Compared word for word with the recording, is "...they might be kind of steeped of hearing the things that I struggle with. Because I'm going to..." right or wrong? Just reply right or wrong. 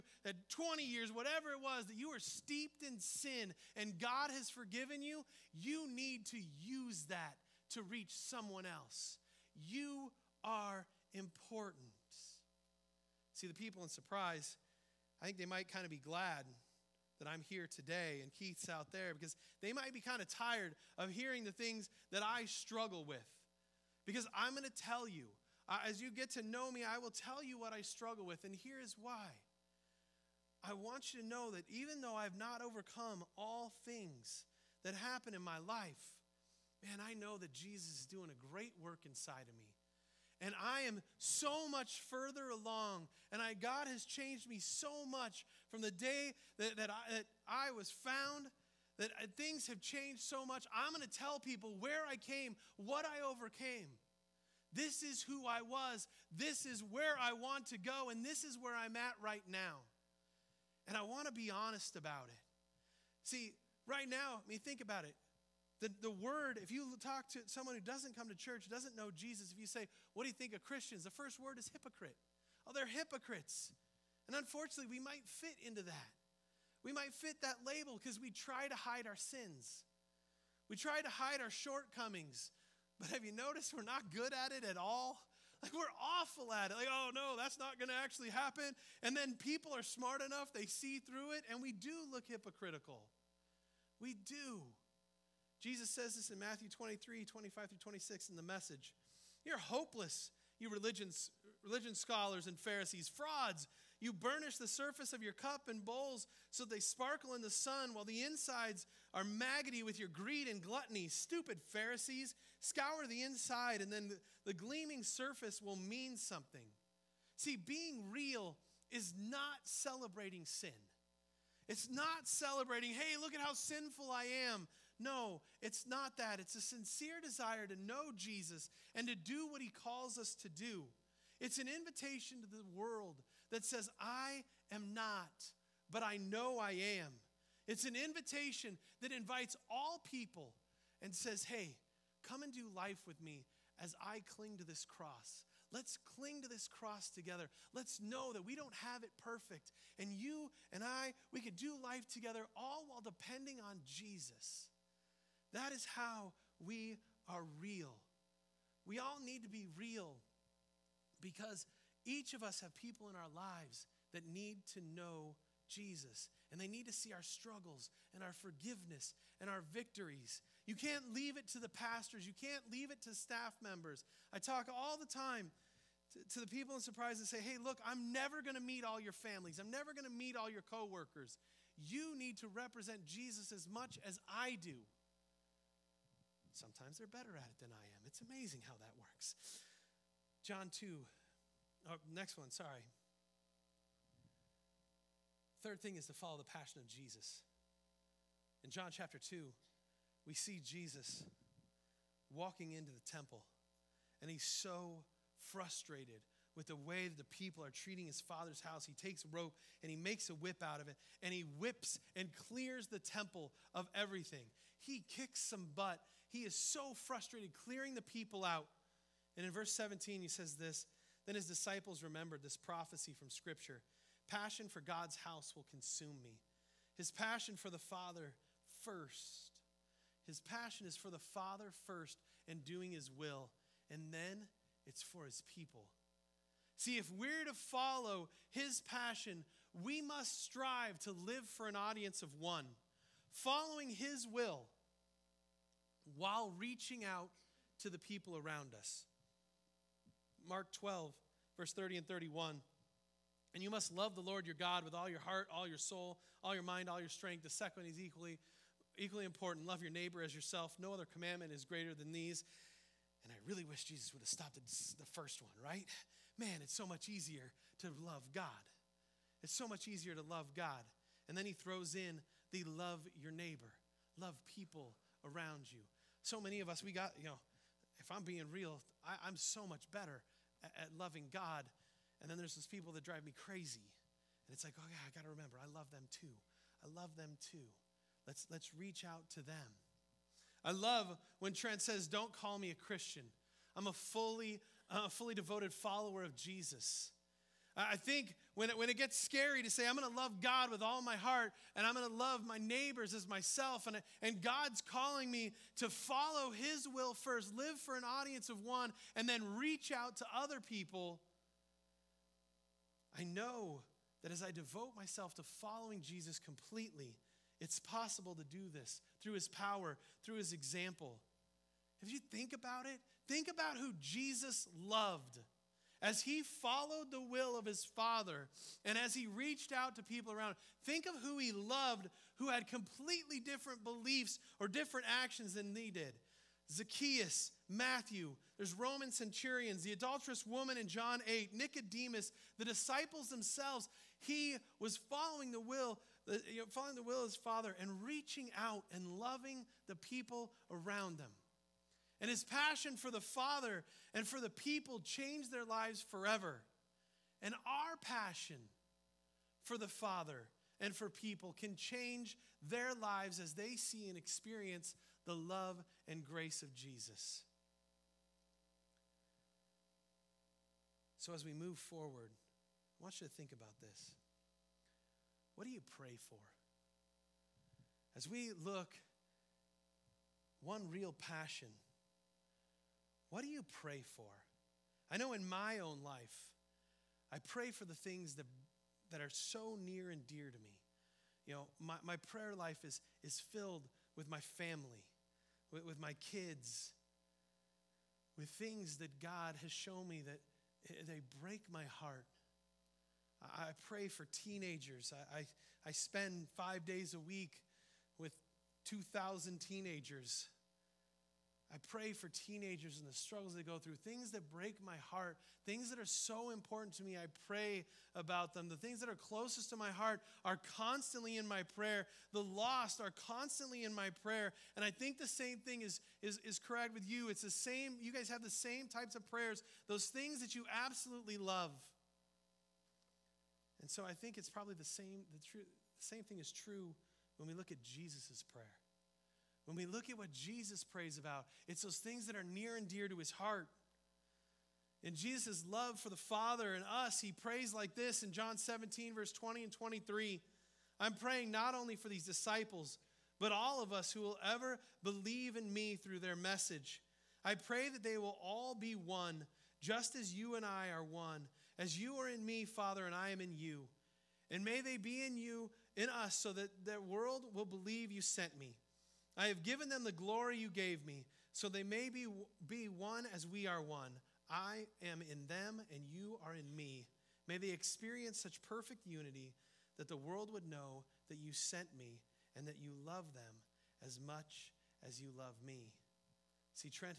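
wrong.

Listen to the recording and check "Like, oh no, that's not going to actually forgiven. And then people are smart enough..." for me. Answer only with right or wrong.
wrong.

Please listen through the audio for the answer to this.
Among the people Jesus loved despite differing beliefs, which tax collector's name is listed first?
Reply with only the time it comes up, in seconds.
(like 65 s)
336 s.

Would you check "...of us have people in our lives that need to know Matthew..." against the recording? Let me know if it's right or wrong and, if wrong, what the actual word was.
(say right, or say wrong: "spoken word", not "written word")
wrong: "Jesus", not "Matthew".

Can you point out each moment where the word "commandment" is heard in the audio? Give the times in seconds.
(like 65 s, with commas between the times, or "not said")
261 s.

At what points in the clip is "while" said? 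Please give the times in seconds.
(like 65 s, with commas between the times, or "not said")
107 s, 152 s, 246 s.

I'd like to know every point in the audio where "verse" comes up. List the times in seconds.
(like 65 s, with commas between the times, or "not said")
219 s, 251 s, 449 s.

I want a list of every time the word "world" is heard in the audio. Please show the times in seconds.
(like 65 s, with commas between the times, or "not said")
132 s, 466 s, 480 s.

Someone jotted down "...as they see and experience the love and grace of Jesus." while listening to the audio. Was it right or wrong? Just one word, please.
right.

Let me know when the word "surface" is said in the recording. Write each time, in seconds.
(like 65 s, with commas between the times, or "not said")
104 s, 115 s.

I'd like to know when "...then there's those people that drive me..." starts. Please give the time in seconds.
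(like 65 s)
282 s.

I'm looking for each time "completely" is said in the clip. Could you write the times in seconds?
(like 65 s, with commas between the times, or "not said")
316 s, 332 s.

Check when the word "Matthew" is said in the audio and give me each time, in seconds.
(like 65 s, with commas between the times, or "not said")
96 s, 337 s.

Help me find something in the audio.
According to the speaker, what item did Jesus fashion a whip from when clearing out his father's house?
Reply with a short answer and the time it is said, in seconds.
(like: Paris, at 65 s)
rope, at 209 s.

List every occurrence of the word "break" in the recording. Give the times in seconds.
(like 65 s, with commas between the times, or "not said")
401 s, 414 s.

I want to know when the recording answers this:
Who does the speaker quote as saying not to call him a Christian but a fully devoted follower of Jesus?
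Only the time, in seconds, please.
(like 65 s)
291 s.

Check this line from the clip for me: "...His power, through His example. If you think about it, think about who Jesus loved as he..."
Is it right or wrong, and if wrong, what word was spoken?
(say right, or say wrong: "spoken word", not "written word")
right.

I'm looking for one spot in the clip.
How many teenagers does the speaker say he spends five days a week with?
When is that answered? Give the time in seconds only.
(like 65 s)
408 s.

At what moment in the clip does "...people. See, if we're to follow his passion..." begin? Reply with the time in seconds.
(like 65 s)
235 s.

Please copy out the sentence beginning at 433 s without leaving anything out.
And so I think it's probably the same, the, true, the same thing is true when we look at Jesus' prayer.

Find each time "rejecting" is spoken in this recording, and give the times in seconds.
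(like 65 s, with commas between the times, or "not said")
not said.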